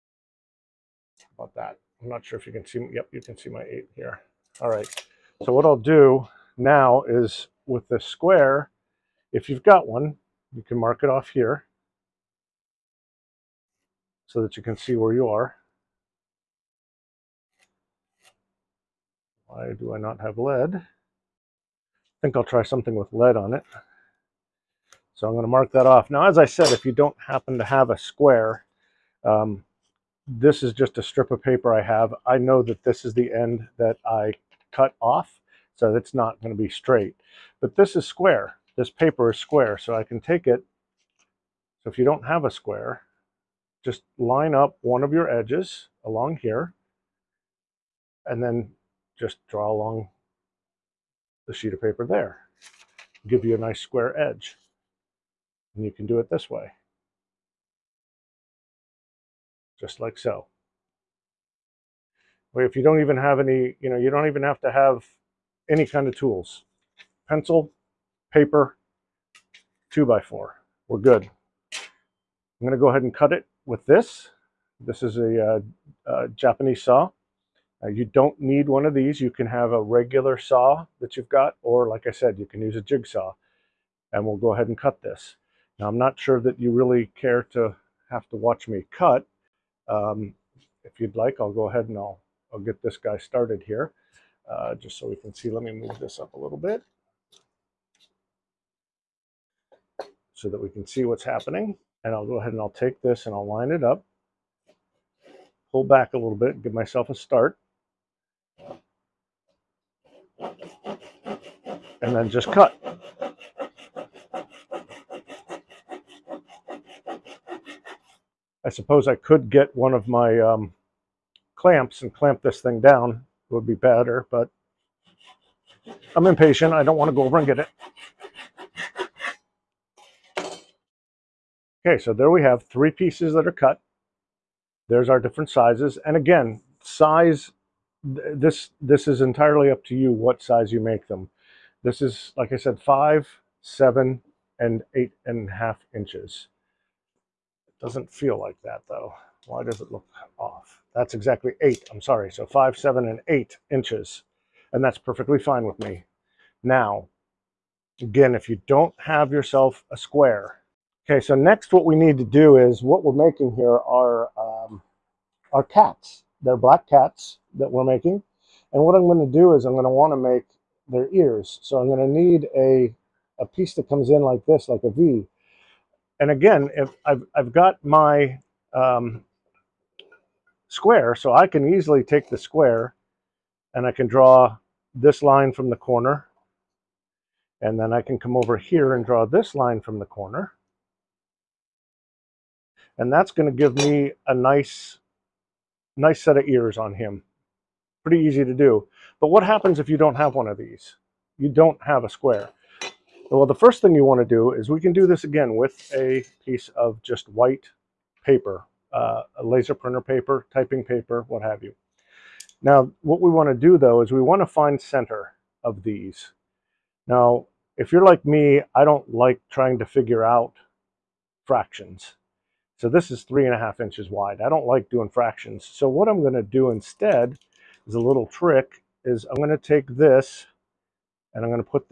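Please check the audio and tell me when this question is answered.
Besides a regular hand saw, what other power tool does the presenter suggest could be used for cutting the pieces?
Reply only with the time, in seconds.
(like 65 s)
82 s.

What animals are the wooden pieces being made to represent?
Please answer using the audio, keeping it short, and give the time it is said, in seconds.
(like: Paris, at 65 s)
black cats, at 166 s.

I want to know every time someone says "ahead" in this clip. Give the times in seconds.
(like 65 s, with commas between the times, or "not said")
72 s, 84 s, 91 s, 102 s.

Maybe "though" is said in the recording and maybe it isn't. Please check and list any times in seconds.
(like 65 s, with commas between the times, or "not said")
148 s, 213 s.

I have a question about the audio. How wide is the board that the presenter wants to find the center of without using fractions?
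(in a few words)
3 and a half inches.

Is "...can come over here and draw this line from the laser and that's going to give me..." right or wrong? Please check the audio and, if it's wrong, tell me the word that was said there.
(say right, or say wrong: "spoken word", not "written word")
wrong: "corner", not "laser".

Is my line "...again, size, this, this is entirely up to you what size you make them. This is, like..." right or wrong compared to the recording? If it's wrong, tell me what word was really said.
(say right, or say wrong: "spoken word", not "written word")
right.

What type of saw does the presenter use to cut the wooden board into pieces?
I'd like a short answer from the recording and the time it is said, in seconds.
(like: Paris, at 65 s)
Japanese saw, at 76 s.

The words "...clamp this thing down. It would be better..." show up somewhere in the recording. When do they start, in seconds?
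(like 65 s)
122 s.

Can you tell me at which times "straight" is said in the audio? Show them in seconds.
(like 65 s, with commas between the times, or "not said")
36 s.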